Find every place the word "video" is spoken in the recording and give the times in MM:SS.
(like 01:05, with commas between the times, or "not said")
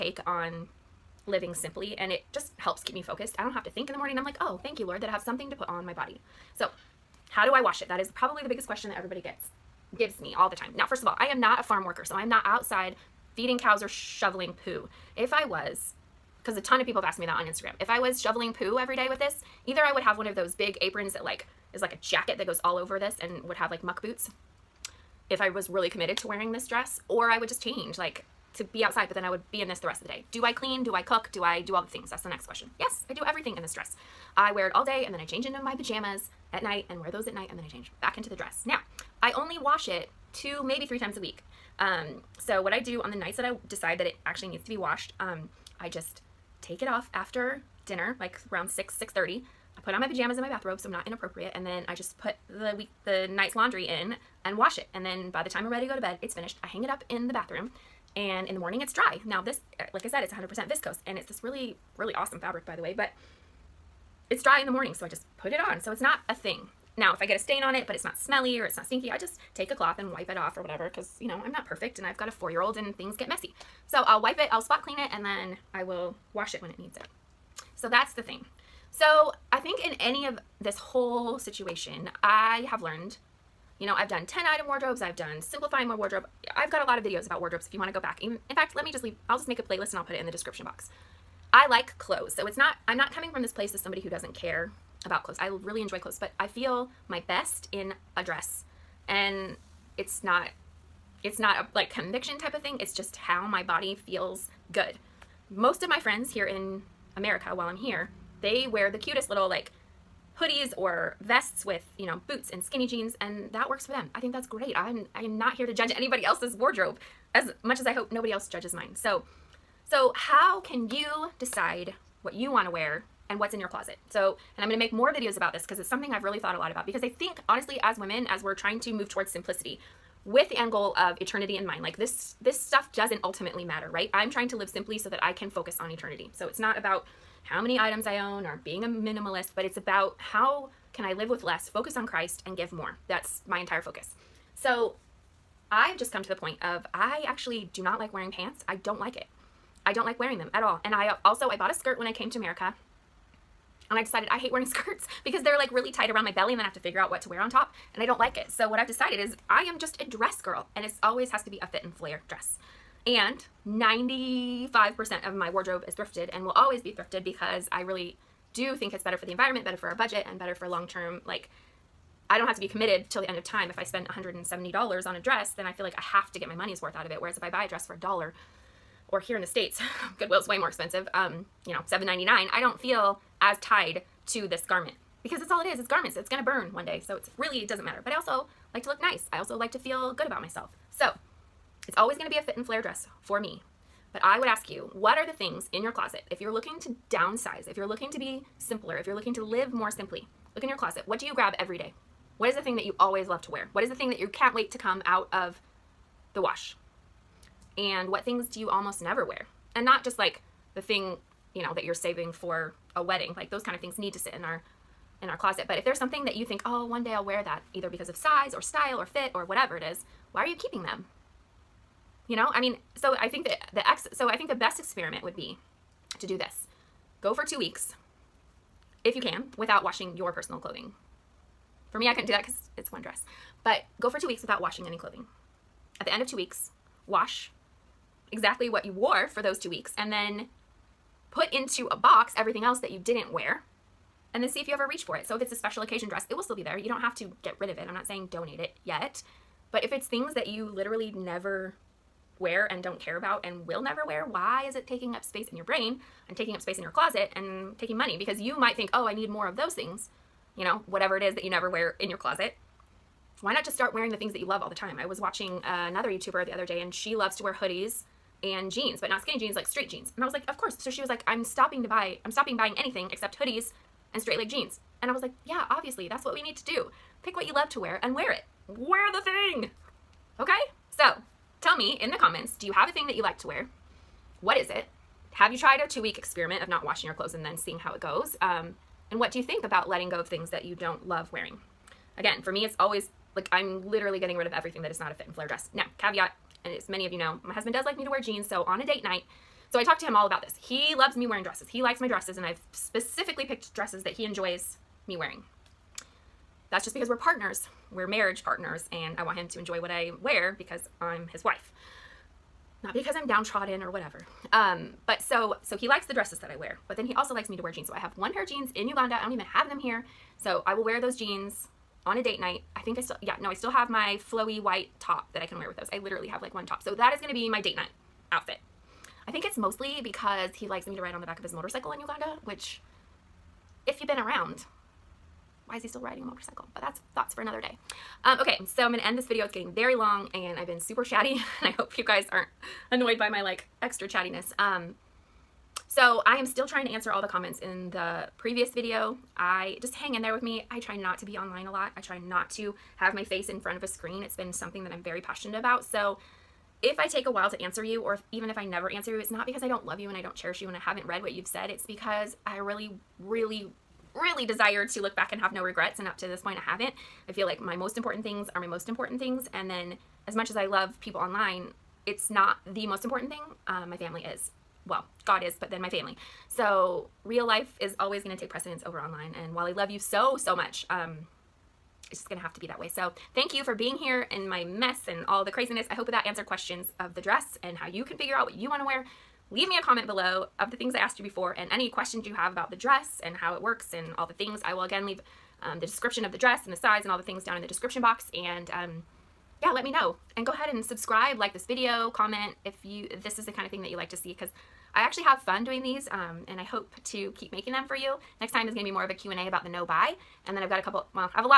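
01:27, 02:05, 05:39, 05:48, 06:41.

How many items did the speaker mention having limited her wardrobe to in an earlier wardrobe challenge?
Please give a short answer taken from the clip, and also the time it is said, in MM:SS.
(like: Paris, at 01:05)
10, at 01:24.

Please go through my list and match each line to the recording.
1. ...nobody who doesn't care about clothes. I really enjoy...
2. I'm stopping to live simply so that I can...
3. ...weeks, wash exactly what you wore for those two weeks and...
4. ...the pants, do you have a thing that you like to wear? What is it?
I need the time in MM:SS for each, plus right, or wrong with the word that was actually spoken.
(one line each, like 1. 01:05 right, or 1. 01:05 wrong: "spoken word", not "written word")
1. 01:33 wrong: "somebody", not "nobody"
2. 02:14 wrong: "trying", not "stopping"
3. 03:56 right
4. 04:42 wrong: "comments", not "pants".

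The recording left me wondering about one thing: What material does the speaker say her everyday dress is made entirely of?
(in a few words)
viscose.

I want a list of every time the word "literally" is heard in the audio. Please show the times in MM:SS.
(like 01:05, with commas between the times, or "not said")
04:10, 04:53, 05:25.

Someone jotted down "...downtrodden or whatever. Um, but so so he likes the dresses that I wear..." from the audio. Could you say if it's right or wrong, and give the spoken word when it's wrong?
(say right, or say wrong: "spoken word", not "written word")
right.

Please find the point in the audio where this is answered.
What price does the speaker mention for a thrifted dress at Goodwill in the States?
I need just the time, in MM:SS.
03:01.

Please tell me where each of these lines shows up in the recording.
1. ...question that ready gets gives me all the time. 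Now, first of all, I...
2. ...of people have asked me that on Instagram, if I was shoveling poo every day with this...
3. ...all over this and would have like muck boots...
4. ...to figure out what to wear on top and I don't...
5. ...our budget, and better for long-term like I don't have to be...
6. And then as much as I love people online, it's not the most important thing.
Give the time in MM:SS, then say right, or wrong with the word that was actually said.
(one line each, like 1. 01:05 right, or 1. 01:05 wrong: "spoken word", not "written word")
1. 00:08 wrong: "everybody", not "ready"
2. 00:16 right
3. 00:22 right
4. 02:36 right
5. 02:49 right
6. 06:09 right.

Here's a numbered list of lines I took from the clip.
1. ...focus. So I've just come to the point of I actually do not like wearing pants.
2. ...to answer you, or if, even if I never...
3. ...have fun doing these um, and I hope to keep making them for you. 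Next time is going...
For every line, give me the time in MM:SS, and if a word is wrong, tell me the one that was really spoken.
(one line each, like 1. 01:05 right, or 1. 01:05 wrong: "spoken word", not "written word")
1. 02:23 right
2. 05:57 right
3. 06:45 right.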